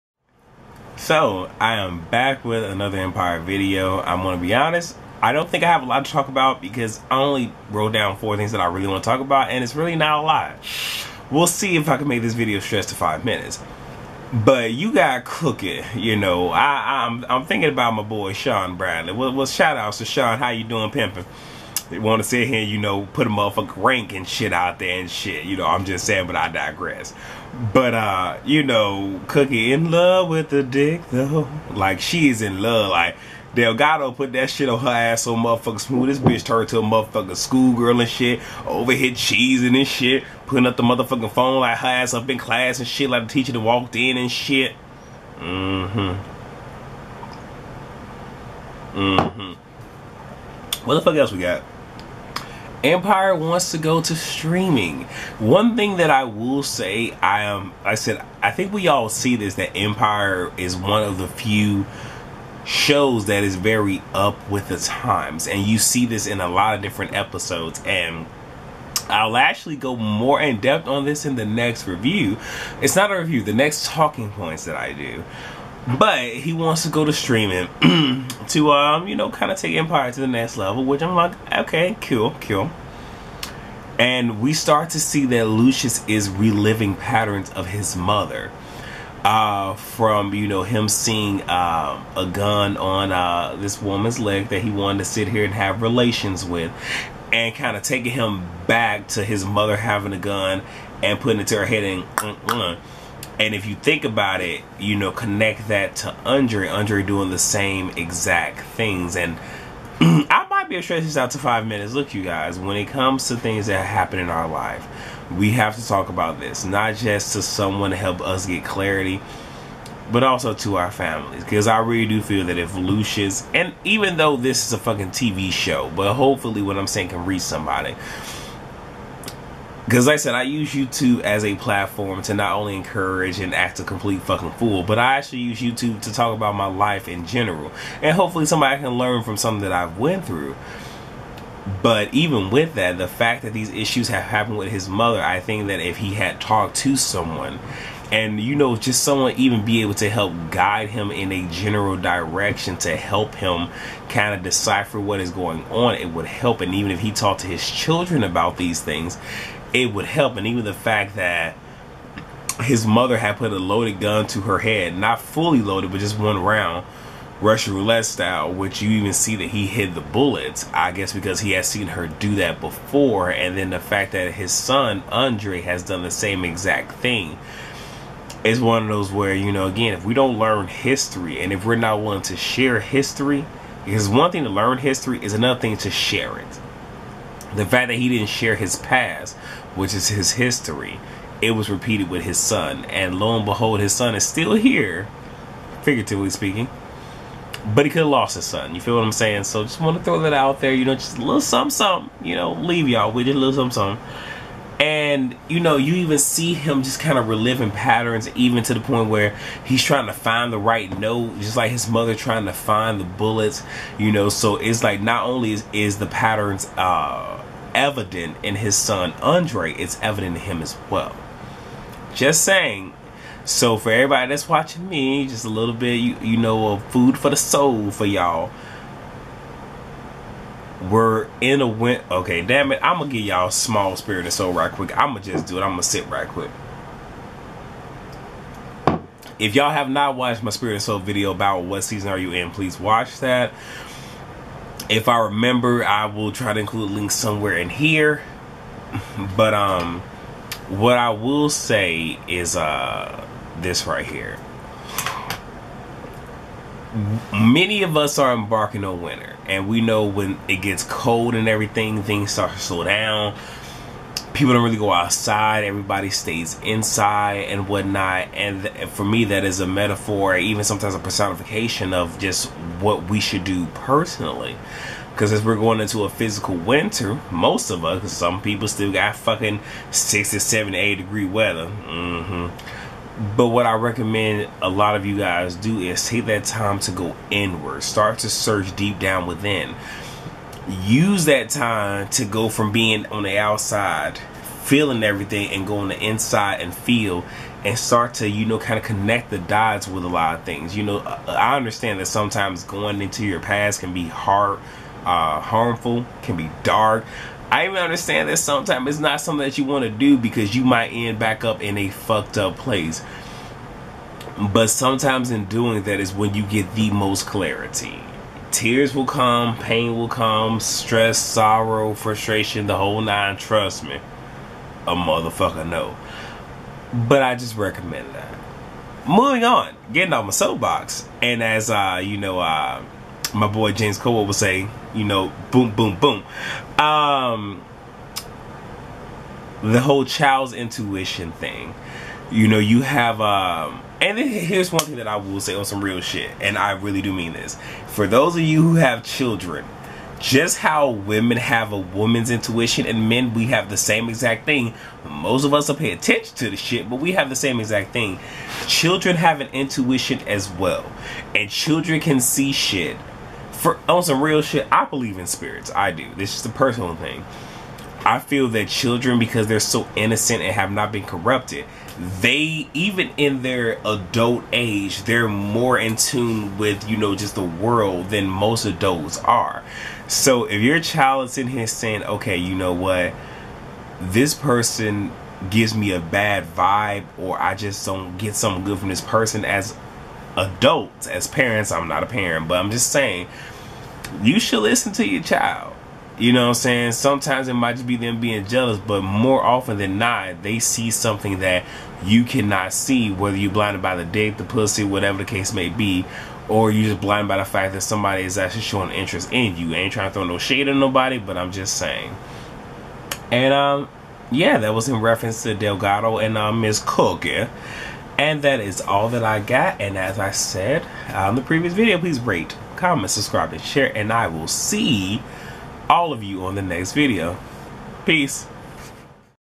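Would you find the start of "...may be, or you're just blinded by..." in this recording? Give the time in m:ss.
6:45.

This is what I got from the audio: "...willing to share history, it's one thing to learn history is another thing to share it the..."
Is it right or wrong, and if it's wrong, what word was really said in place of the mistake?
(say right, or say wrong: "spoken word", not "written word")
right.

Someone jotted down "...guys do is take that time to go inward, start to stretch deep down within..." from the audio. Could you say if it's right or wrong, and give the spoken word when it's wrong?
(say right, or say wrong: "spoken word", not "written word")
wrong: "search", not "stretch".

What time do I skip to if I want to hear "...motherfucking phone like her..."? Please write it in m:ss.
0:40.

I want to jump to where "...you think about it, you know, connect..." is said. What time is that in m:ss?
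1:43.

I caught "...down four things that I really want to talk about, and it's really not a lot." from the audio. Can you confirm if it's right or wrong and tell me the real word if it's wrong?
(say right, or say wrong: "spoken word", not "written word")
right.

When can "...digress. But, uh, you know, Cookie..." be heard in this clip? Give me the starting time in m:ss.
0:26.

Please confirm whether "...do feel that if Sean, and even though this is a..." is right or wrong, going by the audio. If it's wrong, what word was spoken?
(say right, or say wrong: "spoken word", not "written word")
wrong: "Lucius", not "Sean".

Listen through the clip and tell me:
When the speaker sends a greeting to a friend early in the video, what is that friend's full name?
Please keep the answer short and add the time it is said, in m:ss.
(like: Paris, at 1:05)
Sean Bradley, at 0:18.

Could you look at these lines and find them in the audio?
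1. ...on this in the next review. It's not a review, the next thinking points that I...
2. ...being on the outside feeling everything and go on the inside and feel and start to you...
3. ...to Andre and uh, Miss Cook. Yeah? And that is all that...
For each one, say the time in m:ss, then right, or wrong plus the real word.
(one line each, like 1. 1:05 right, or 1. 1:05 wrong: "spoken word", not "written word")
1. 1:10 wrong: "talking", not "thinking"
2. 4:52 right
3. 6:55 wrong: "Delgado", not "Andre".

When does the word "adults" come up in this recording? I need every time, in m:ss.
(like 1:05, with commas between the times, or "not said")
6:13, 6:18, 6:30.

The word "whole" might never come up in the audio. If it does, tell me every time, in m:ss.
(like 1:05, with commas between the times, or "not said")
5:22, 5:39.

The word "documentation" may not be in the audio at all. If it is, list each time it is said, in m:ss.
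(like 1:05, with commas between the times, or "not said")
not said.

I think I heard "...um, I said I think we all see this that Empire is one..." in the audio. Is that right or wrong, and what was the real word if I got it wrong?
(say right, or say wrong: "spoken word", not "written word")
right.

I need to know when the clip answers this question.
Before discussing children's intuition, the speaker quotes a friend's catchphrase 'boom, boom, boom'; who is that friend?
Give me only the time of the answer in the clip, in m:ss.
5:33.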